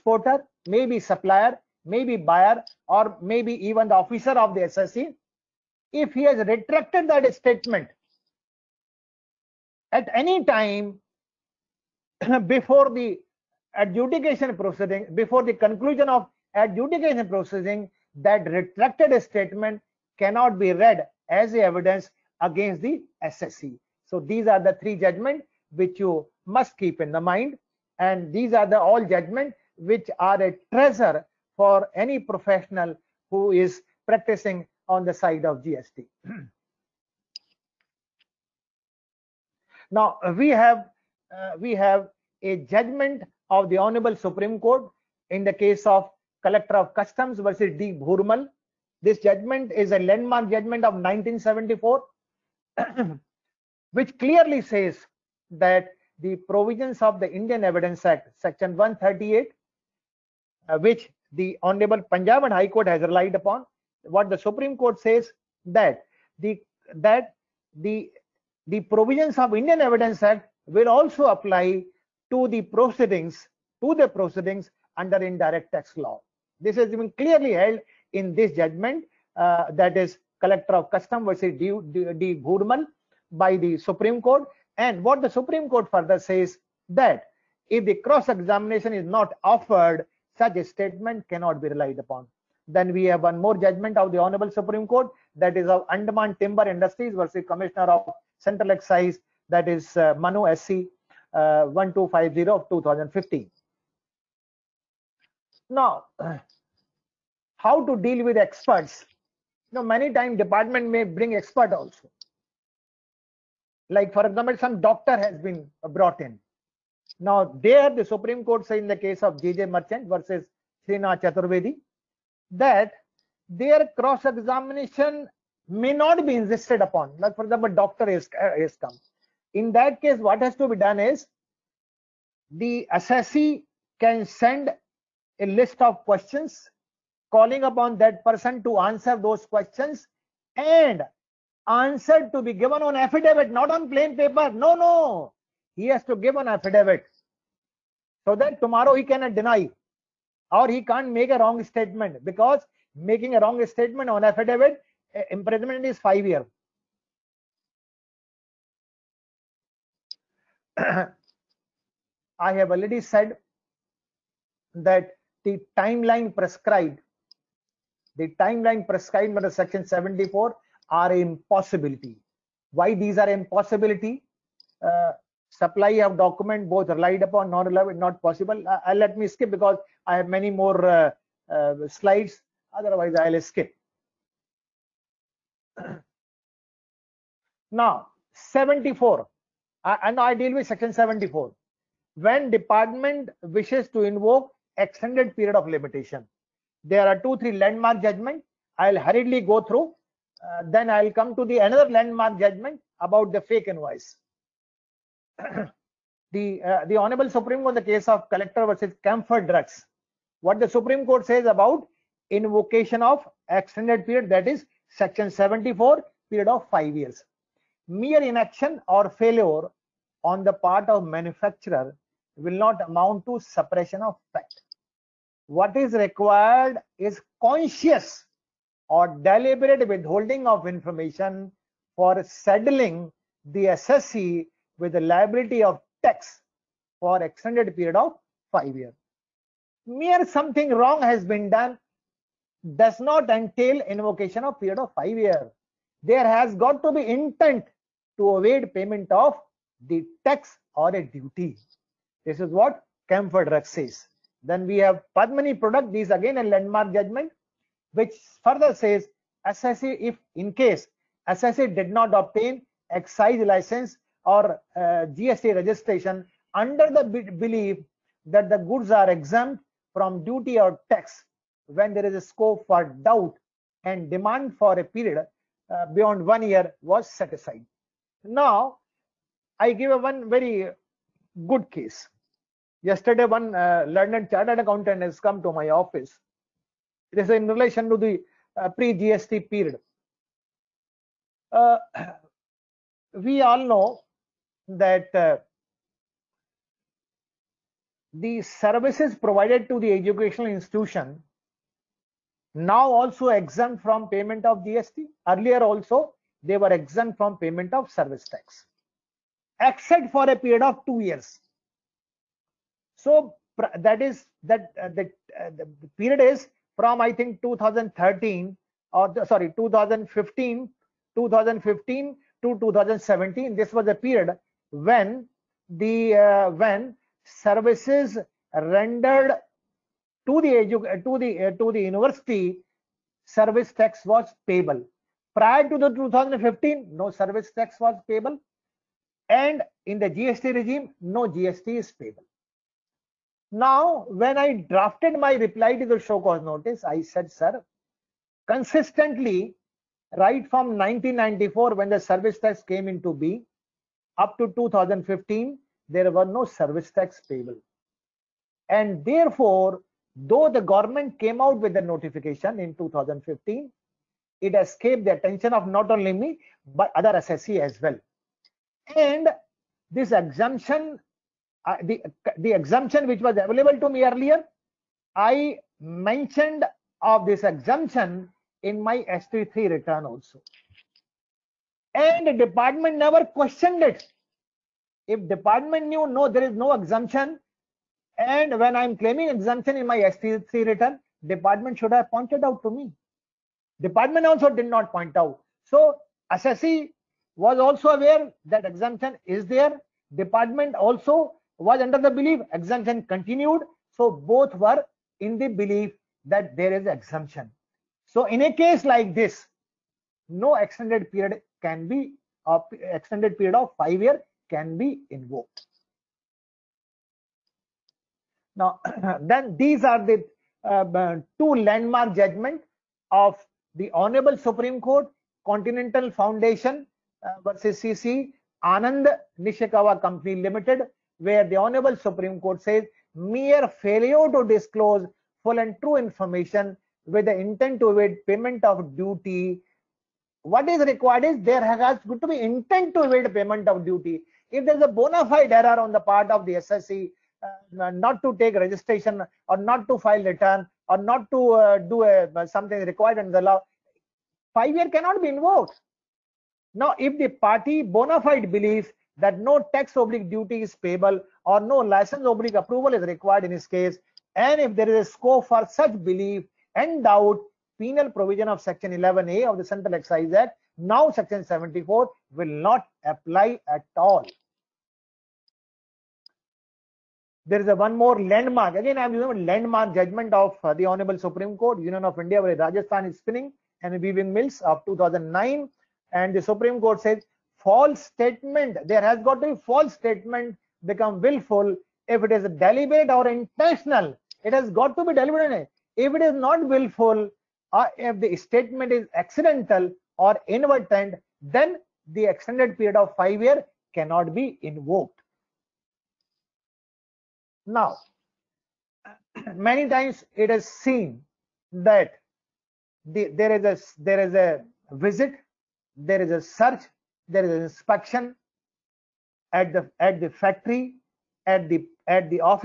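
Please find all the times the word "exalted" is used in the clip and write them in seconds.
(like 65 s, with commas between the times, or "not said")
not said.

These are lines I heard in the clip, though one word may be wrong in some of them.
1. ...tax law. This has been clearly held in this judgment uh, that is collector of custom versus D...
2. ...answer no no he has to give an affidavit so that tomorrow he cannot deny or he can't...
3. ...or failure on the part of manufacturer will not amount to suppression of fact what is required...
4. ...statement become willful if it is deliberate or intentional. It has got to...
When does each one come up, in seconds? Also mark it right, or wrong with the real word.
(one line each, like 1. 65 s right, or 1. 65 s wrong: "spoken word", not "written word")
1. 75 s right
2. 144 s wrong: "paper", not "answer"
3. 218 s right
4. 489 s right.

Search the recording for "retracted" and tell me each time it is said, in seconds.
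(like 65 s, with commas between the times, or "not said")
6 s, 18 s.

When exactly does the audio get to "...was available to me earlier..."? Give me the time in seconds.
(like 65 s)
373 s.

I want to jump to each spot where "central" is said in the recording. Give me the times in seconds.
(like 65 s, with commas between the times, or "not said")
98 s, 469 s.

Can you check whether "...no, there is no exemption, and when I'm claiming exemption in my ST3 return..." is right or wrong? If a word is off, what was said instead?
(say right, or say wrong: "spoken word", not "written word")
right.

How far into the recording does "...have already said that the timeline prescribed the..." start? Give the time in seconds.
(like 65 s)
162 s.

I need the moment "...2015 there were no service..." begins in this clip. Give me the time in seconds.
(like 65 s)
354 s.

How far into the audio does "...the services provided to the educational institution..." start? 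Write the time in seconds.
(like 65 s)
298 s.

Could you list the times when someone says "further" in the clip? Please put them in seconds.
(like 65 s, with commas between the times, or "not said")
85 s, 258 s.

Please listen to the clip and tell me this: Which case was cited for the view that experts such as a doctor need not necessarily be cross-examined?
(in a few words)
J.J. Merchant versus Srinath Chaturvedi.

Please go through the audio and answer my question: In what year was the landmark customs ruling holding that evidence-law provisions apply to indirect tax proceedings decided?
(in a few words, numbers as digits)
1974.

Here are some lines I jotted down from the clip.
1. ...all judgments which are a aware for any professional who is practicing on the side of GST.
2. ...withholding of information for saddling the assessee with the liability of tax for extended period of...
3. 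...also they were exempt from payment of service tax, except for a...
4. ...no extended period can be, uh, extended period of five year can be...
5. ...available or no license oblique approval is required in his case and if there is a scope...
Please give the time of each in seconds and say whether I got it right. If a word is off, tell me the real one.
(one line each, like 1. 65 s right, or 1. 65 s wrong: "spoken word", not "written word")
1. 28 s wrong: "treasure", not "aware"
2. 229 s right
3. 305 s right
4. 410 s right
5. 460 s wrong: "payable", not "available".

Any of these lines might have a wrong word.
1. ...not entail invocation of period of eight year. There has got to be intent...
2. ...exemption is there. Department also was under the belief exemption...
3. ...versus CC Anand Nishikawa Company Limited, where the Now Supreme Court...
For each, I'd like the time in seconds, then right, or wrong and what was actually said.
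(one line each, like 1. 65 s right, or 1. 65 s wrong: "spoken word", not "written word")
1. 242 s wrong: "five", not "eight"
2. 398 s right
3. 427 s wrong: "Honorable", not "Now".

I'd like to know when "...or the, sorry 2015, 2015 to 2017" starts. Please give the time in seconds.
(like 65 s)
318 s.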